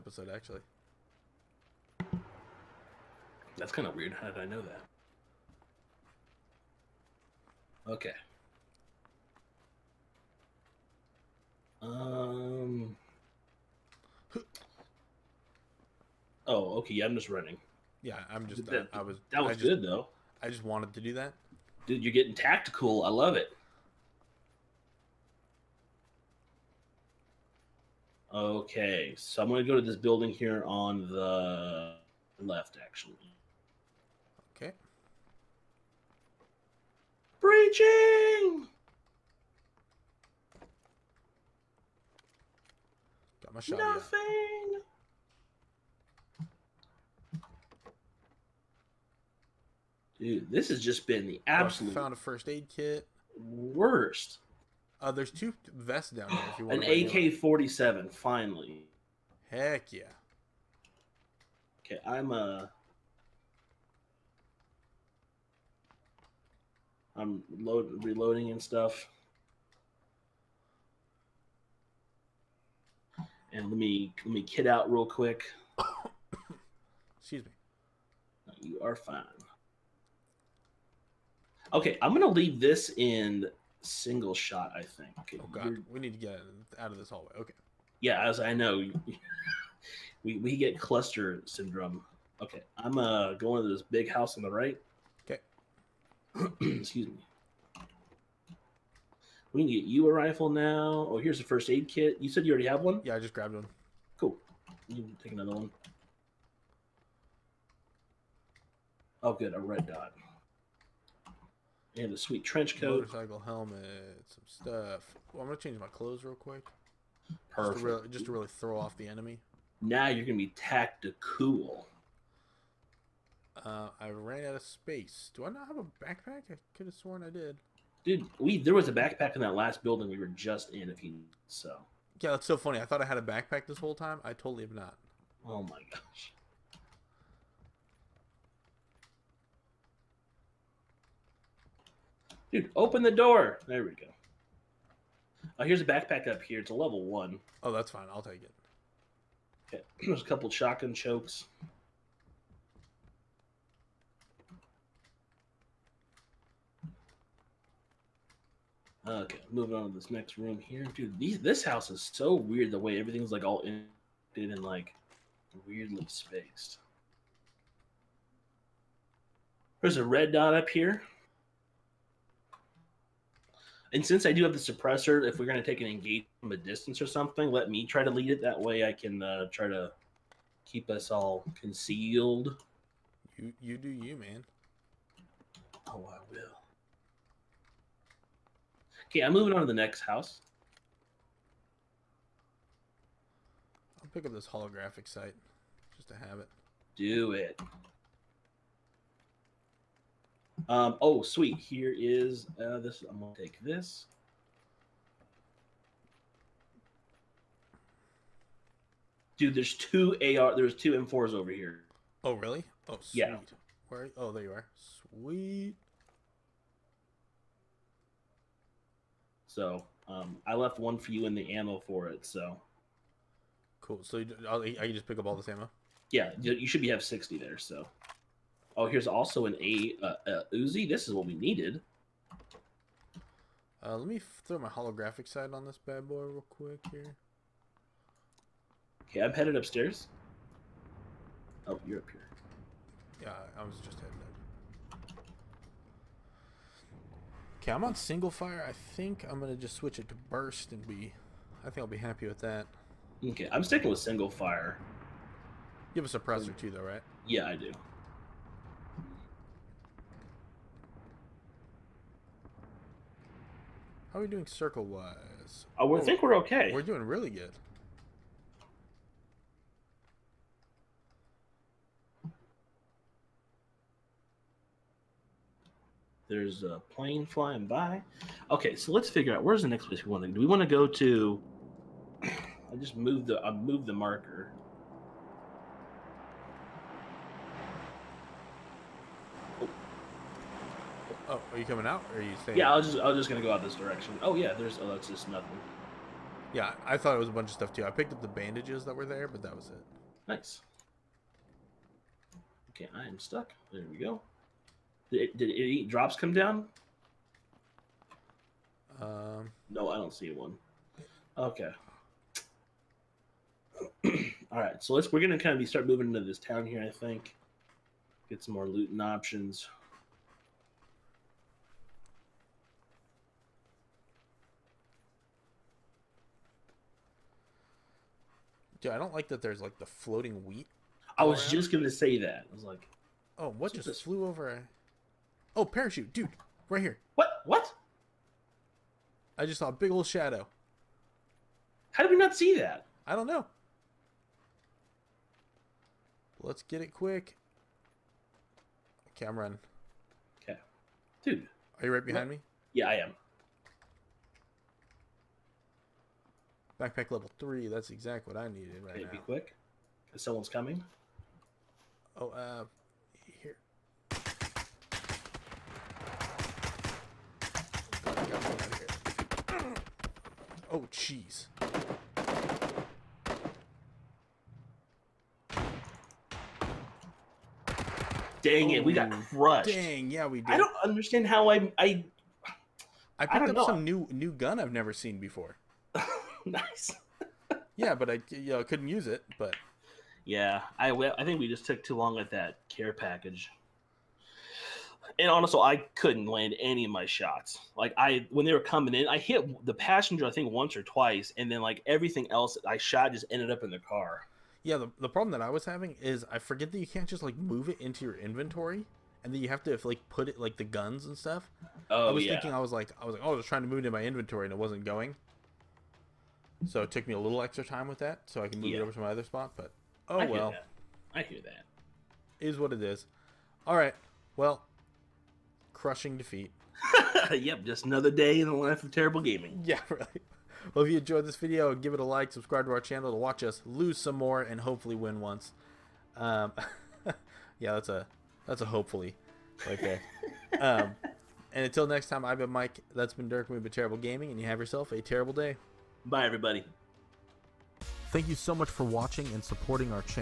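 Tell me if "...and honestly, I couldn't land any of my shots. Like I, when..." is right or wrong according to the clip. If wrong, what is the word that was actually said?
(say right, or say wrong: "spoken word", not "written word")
right.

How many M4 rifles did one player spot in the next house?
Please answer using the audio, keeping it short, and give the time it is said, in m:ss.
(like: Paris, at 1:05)
2, at 3:30.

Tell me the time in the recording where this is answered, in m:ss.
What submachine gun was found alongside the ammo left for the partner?
3:50.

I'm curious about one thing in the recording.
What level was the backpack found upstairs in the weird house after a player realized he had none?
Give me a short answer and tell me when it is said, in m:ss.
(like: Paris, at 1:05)
Level 1, at 2:26.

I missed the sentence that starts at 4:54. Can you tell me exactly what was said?
Oh yeah, there's oh that's just nothing.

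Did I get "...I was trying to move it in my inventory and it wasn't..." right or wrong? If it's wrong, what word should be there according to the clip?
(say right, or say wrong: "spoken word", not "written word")
right.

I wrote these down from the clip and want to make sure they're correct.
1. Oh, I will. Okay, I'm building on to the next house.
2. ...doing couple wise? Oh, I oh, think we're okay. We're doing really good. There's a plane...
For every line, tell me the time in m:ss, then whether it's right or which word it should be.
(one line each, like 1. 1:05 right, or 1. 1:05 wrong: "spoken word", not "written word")
1. 3:05 wrong: "moving", not "building"
2. 4:24 wrong: "circle", not "couple".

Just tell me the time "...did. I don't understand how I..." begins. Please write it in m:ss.
6:20.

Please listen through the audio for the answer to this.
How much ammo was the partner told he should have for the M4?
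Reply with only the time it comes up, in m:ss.
3:47.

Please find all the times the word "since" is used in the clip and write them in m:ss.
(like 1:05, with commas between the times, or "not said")
2:54.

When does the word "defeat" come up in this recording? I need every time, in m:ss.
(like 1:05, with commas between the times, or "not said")
7:06.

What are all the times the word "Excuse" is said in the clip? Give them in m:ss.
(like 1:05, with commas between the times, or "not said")
1:17, 1:36.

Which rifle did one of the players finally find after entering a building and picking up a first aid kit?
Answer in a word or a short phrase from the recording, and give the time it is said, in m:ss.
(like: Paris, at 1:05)
AK-47, at 0:56.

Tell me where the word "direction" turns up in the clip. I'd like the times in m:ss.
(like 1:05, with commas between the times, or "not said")
4:53.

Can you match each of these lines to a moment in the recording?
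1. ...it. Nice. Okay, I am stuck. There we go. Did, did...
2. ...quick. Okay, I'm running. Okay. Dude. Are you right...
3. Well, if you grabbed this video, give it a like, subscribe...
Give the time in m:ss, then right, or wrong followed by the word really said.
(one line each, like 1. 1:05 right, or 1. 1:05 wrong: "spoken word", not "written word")
1. 4:59 right
2. 5:46 right
3. 7:10 wrong: "enjoyed", not "grabbed".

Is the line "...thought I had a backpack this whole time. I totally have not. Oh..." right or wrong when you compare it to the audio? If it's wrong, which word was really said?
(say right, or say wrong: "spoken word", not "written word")
right.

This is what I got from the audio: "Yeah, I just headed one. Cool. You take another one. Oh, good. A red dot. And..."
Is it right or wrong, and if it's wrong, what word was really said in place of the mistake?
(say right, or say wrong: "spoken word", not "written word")
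wrong: "grabbed", not "headed".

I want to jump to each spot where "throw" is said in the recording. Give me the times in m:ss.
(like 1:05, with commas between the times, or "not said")
1:58, 3:54.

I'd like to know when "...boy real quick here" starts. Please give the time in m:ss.
3:56.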